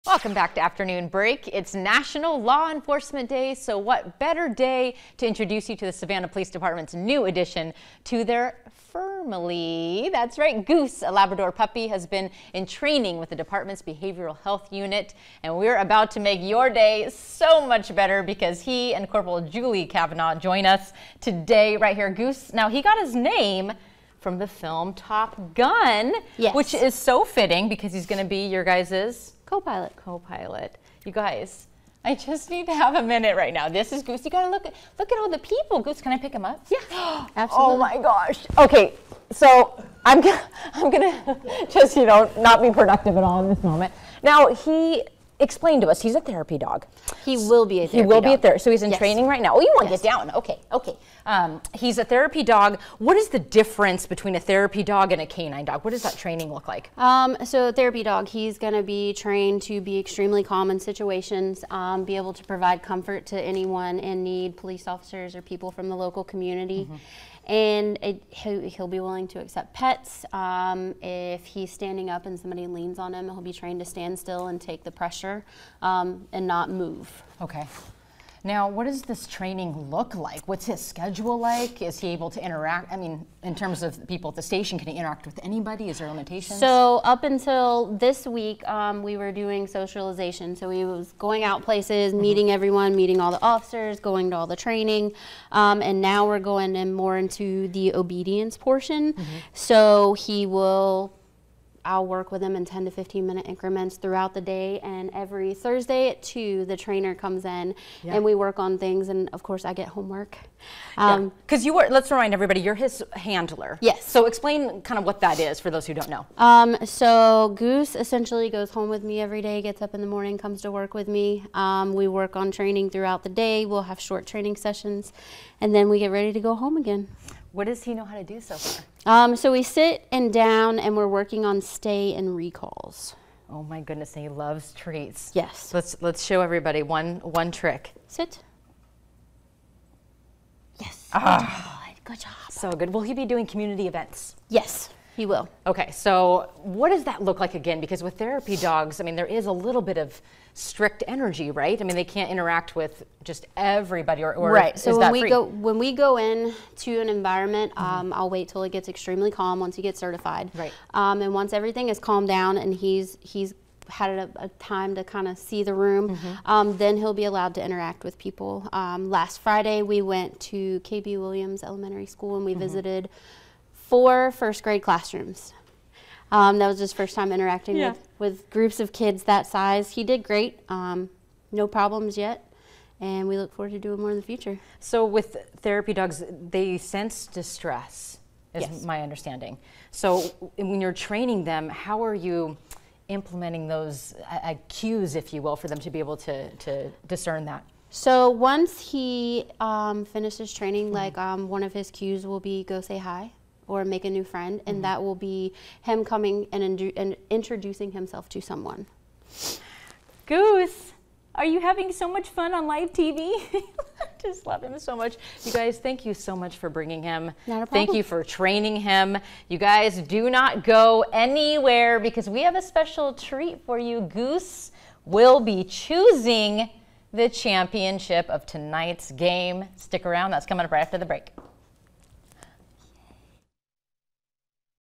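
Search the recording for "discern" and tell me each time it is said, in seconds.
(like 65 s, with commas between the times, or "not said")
197 s.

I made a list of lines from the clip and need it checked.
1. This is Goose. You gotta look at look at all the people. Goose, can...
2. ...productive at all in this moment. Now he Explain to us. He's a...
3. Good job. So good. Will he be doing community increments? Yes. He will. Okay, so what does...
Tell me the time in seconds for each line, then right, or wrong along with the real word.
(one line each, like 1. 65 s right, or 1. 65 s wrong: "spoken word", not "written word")
1. 33 s right
2. 42 s right
3. 142 s wrong: "events", not "increments".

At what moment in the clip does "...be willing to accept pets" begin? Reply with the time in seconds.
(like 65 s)
68 s.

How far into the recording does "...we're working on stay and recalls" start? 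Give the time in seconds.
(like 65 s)
130 s.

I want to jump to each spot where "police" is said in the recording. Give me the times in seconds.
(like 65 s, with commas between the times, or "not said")
6 s, 64 s.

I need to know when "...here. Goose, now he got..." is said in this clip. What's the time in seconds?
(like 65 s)
21 s.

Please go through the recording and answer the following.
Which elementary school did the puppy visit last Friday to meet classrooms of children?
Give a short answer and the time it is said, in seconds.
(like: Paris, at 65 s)
KB Williams Elementary School, at 170 s.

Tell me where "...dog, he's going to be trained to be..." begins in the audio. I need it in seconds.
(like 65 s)
58 s.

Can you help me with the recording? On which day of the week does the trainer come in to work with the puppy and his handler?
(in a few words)
Thursday.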